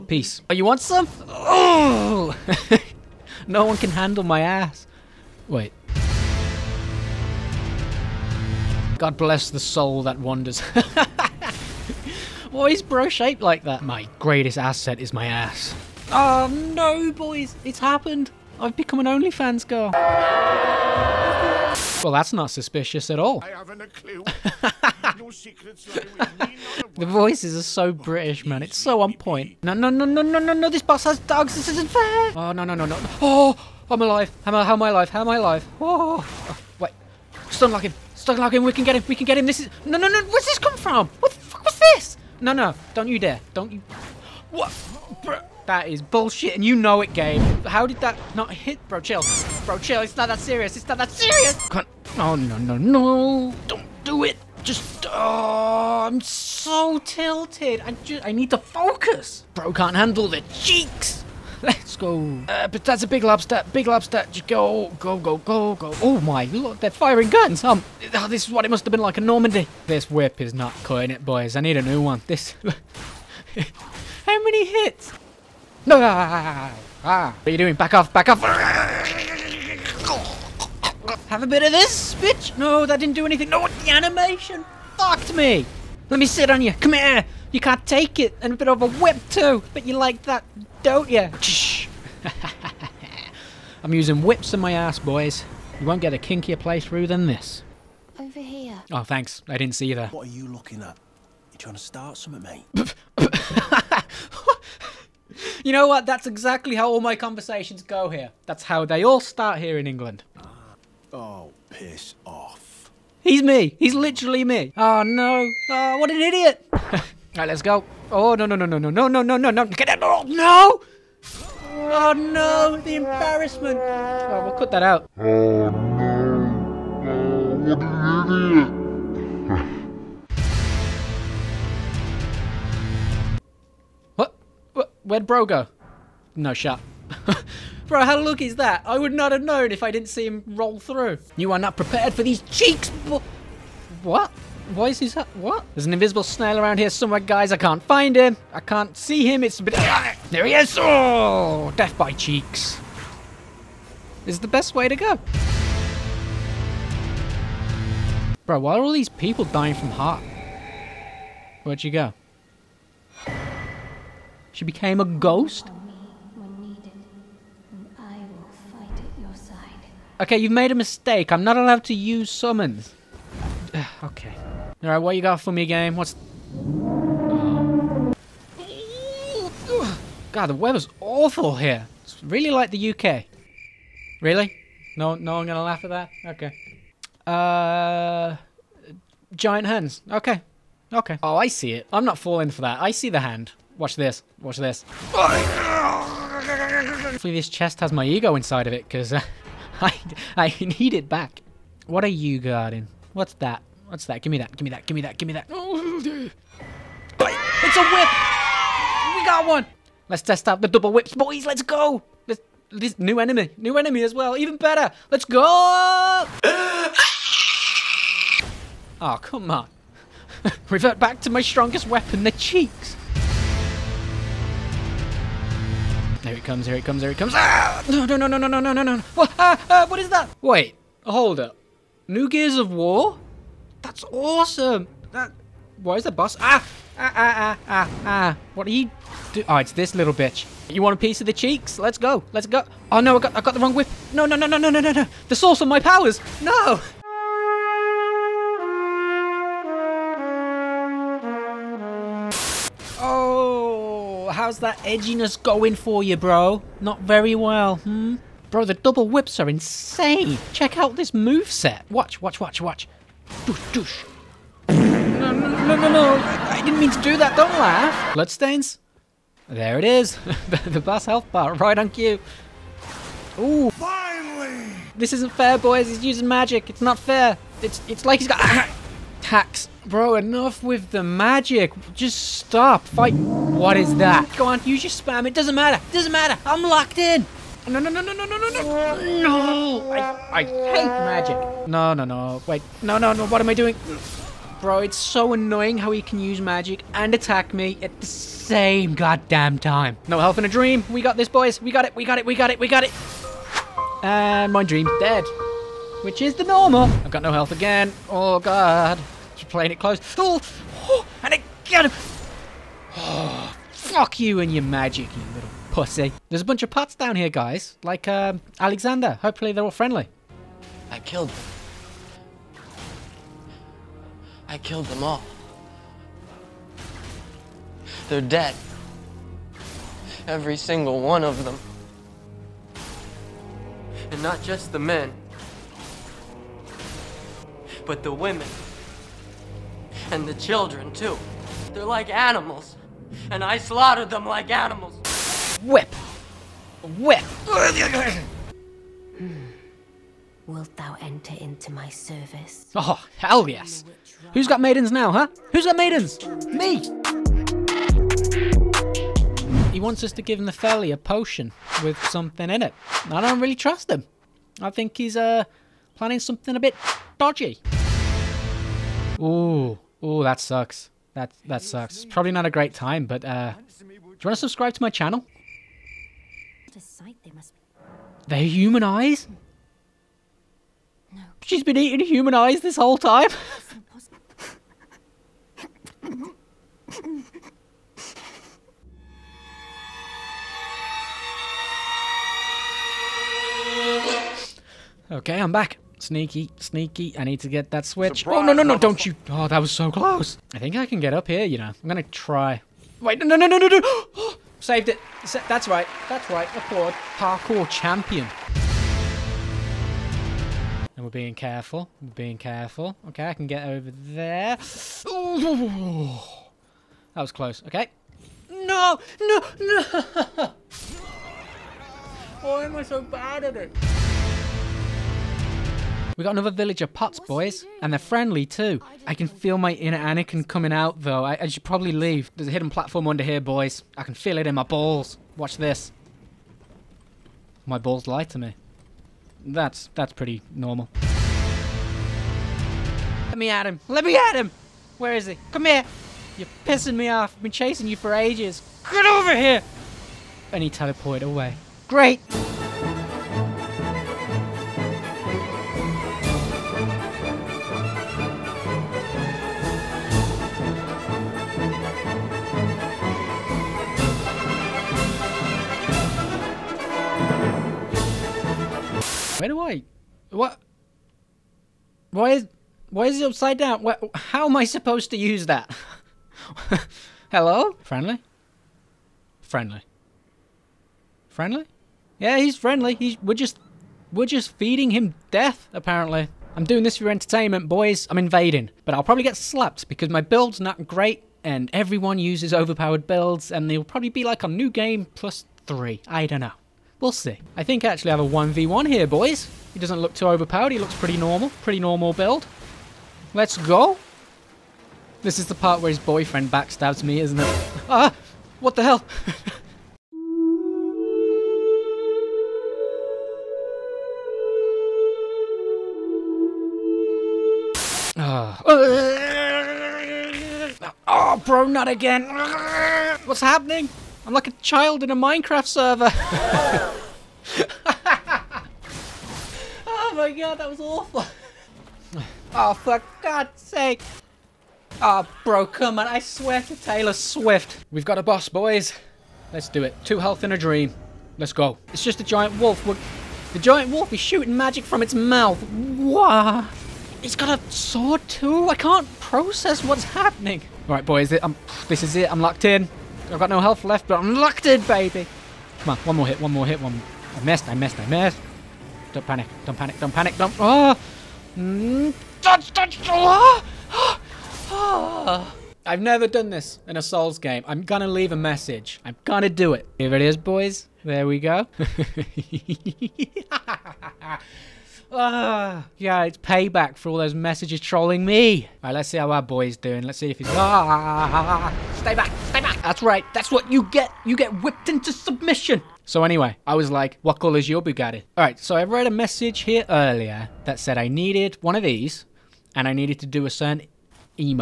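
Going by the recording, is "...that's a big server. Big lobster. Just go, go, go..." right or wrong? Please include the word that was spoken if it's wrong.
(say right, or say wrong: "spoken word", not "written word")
wrong: "lobster", not "server".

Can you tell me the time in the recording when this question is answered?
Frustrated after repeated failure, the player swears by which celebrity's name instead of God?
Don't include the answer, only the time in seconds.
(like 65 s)
536 s.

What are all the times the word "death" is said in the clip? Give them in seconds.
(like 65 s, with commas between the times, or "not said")
151 s, 485 s.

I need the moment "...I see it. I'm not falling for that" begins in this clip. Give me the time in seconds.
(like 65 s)
191 s.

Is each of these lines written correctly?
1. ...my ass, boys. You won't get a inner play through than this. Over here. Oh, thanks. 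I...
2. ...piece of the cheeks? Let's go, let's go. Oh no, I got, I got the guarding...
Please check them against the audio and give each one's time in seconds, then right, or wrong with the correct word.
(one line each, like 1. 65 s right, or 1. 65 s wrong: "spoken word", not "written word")
1. 94 s wrong: "kinkier", not "inner"
2. 240 s wrong: "wrong", not "guarding".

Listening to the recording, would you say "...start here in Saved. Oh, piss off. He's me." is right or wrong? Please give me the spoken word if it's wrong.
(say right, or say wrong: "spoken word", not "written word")
wrong: "England", not "Saved".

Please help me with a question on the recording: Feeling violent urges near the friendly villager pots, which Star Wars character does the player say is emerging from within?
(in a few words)
Anakin.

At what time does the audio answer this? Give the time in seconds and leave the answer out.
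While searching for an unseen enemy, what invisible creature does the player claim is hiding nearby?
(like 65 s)
146 s.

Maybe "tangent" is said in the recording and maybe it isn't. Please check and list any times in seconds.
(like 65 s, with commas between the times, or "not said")
not said.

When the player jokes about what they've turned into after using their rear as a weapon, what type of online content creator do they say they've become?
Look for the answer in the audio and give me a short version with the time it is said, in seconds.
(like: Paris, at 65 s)
OnlyFans girl, at 19 s.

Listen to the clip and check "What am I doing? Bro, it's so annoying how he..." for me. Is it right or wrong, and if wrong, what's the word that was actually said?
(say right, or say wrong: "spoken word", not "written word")
right.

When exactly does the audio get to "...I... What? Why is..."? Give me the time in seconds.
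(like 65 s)
469 s.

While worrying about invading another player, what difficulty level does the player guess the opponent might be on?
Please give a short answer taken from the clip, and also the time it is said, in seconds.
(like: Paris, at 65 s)
new game plus three, at 494 s.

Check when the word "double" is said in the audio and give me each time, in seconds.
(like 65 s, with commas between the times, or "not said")
210 s, 258 s.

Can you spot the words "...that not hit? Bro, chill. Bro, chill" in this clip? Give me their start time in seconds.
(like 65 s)
47 s.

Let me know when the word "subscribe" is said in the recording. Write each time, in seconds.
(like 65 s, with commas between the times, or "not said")
374 s.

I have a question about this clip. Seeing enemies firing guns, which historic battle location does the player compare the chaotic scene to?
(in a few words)
Normandy.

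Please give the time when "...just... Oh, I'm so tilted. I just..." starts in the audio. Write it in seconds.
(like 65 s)
54 s.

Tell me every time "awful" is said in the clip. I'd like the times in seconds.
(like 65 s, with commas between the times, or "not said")
181 s, 530 s.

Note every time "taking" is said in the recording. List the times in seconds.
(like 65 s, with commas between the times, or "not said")
not said.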